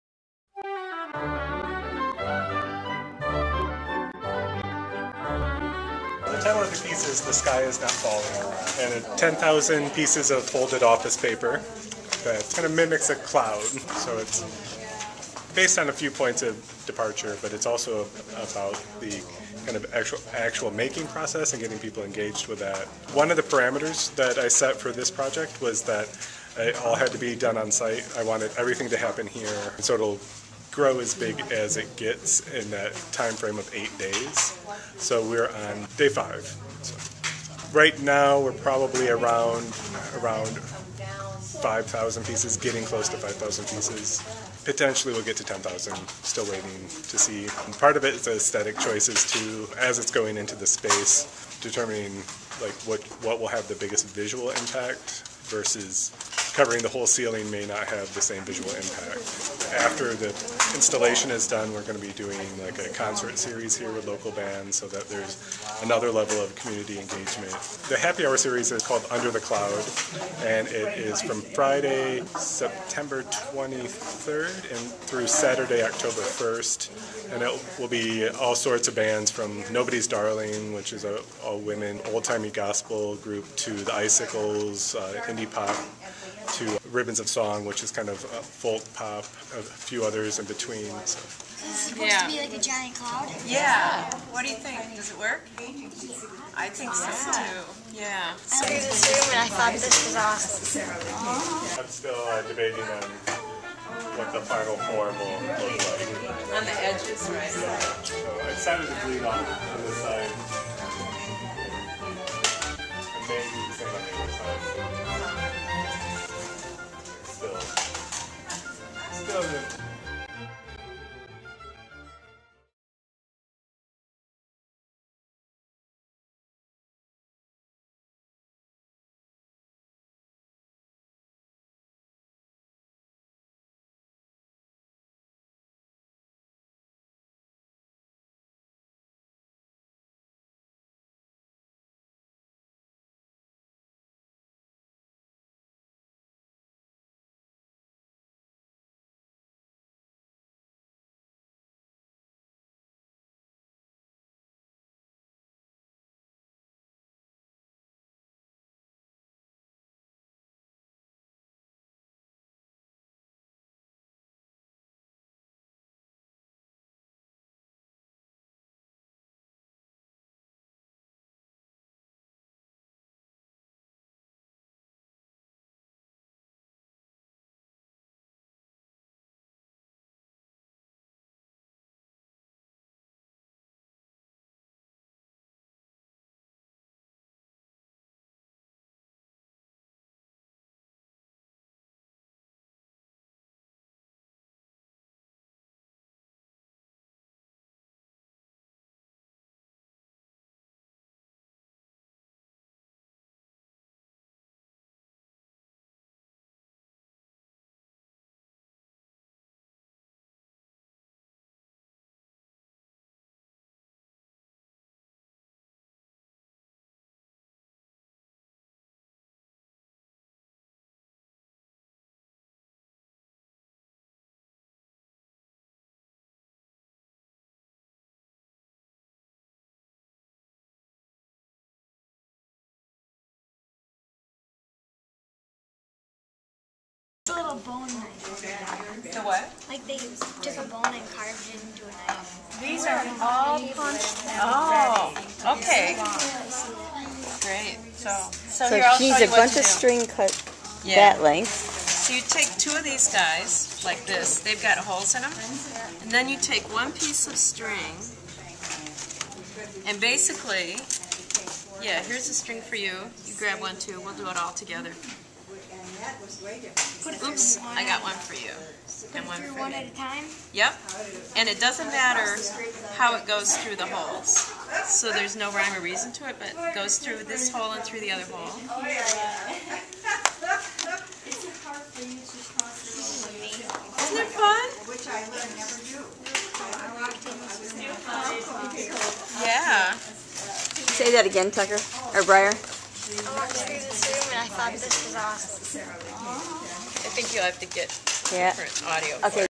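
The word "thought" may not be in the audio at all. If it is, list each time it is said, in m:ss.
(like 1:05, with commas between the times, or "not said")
1:39, 4:54.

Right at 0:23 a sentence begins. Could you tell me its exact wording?
One of the parameters that I set for this project was that it all had to be done on site.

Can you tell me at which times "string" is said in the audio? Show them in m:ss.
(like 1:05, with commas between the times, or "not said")
4:09, 4:17, 4:22.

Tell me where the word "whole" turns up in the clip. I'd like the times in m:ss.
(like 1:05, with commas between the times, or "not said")
0:56.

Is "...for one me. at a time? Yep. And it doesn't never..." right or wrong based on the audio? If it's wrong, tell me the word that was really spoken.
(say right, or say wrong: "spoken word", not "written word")
wrong: "matter", not "never".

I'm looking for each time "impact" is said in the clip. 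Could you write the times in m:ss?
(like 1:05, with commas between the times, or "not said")
0:54, 0:58.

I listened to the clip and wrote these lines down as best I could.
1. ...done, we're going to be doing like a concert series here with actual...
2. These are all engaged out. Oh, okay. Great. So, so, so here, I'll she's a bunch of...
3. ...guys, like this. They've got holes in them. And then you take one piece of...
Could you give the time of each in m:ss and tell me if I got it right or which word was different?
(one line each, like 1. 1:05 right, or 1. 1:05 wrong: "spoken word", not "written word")
1. 1:01 wrong: "local", not "actual"
2. 4:02 wrong: "punched", not "engaged"
3. 4:13 right.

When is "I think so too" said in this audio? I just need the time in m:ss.
1:36.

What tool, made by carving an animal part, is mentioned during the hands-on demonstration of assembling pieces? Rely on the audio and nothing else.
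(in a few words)
bone knife.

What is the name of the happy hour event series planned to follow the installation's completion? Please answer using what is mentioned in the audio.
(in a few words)
Under the Cloud.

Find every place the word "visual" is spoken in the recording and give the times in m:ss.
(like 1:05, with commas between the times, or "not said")
0:54, 0:58.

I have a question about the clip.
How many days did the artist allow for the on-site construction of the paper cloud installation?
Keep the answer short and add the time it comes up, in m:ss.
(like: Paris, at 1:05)
8, at 0:33.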